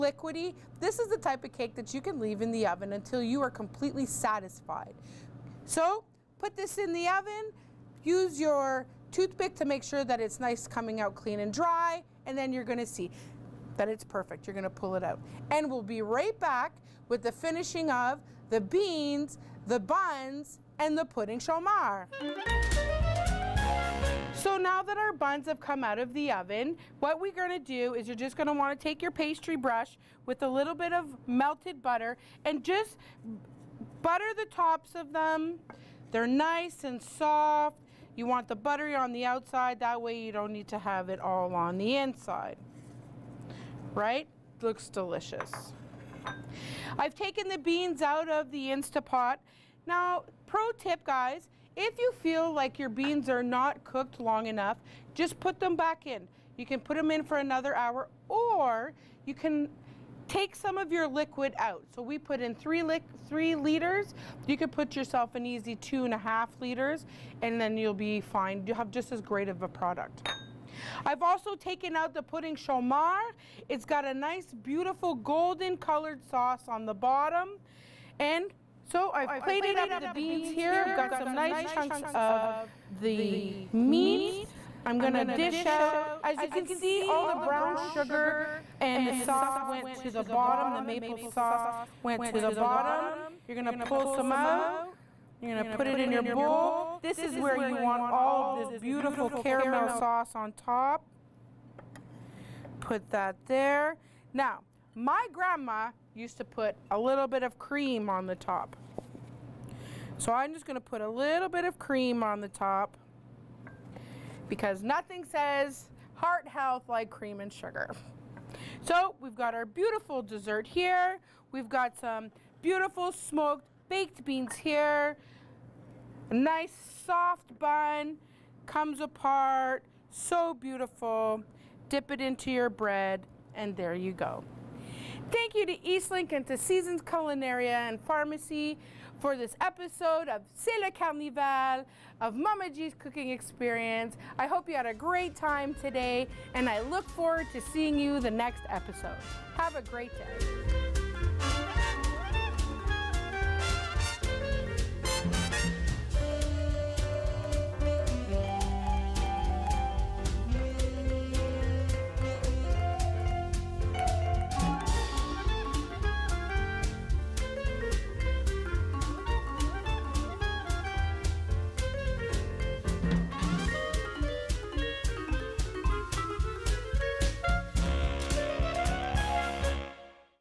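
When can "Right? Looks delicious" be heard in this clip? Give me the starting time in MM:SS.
00:43.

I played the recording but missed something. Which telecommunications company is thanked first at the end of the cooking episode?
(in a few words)
Eastlink.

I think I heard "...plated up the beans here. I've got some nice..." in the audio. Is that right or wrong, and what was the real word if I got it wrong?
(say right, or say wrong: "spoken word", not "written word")
right.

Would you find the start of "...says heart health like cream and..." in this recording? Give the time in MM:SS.
01:55.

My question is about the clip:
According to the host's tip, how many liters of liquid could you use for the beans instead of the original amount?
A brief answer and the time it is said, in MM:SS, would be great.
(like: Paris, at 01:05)
2.5 liters, at 01:05.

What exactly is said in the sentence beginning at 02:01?
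We've got some beautiful smoked baked beans here.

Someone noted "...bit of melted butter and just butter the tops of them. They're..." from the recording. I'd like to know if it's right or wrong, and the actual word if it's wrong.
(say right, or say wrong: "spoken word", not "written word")
right.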